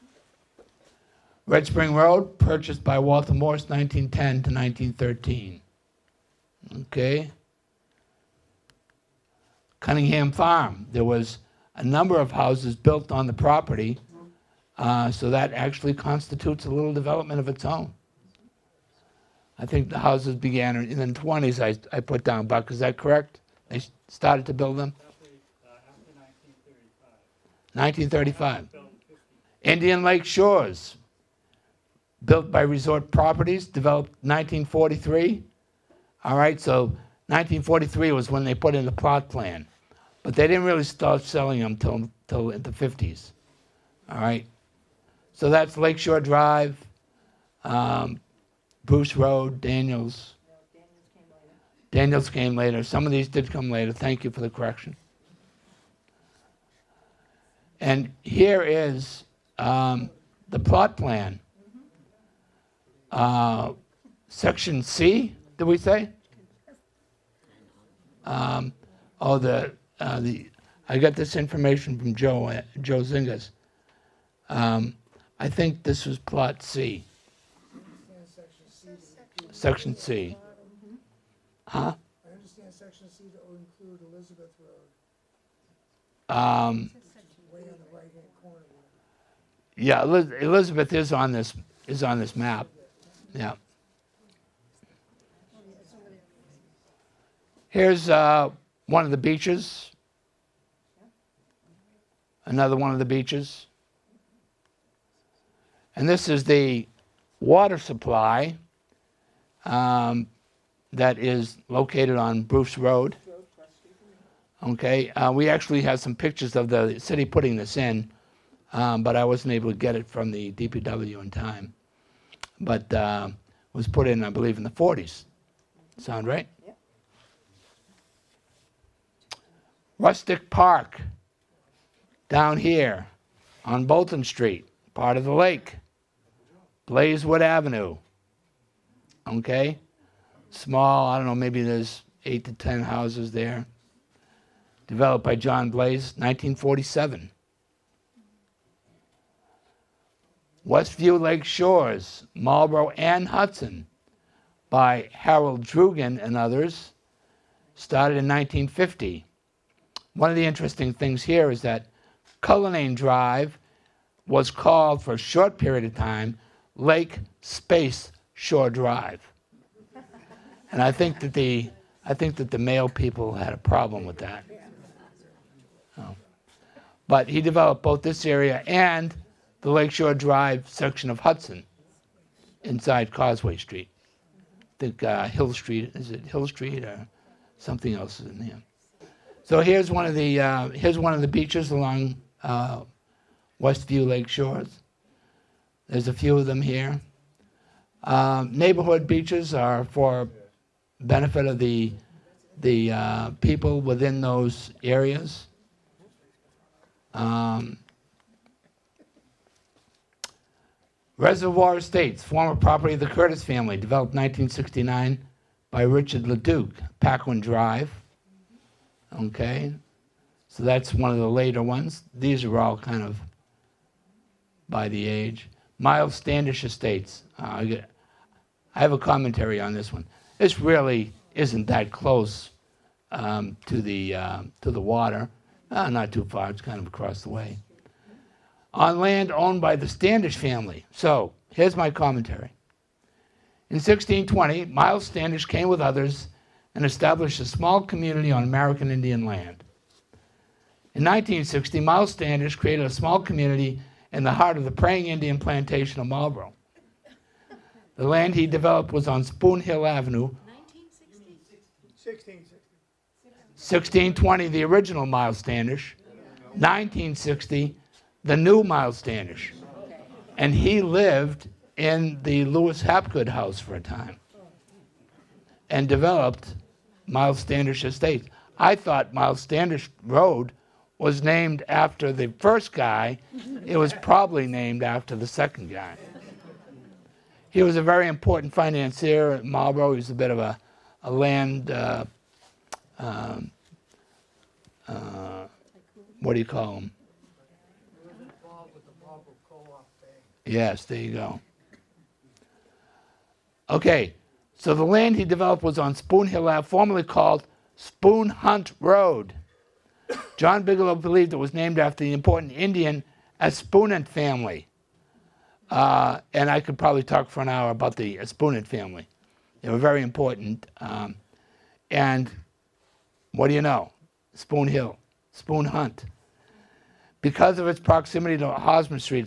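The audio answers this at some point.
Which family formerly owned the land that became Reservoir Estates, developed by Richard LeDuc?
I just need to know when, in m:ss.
3:33.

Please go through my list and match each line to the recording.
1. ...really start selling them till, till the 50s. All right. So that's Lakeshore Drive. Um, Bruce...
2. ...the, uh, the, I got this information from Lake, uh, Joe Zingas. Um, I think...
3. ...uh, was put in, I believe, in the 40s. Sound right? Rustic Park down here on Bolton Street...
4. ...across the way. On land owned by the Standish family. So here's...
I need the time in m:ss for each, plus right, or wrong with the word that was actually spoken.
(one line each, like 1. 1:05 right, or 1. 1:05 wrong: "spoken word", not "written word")
1. 0:40 right
2. 1:09 wrong: "Joe", not "Lake"
3. 2:02 right
4. 3:56 right.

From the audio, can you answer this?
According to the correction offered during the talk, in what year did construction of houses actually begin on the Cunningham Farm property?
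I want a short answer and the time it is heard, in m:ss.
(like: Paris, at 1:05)
1935, at 0:27.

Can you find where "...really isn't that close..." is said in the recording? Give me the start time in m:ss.
3:50.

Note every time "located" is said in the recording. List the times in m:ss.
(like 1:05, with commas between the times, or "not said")
1:51.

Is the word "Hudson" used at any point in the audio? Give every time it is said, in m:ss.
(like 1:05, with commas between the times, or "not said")
2:33, 3:01.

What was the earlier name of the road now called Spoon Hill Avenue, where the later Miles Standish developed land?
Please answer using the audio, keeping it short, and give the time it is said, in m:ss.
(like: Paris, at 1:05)
Spoon Hunt Road, at 5:07.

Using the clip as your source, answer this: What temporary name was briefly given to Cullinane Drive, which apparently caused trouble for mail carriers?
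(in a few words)
Lake Space Shore Drive.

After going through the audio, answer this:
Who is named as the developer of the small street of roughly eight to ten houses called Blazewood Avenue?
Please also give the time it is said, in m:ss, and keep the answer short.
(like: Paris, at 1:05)
John Blaze, at 2:25.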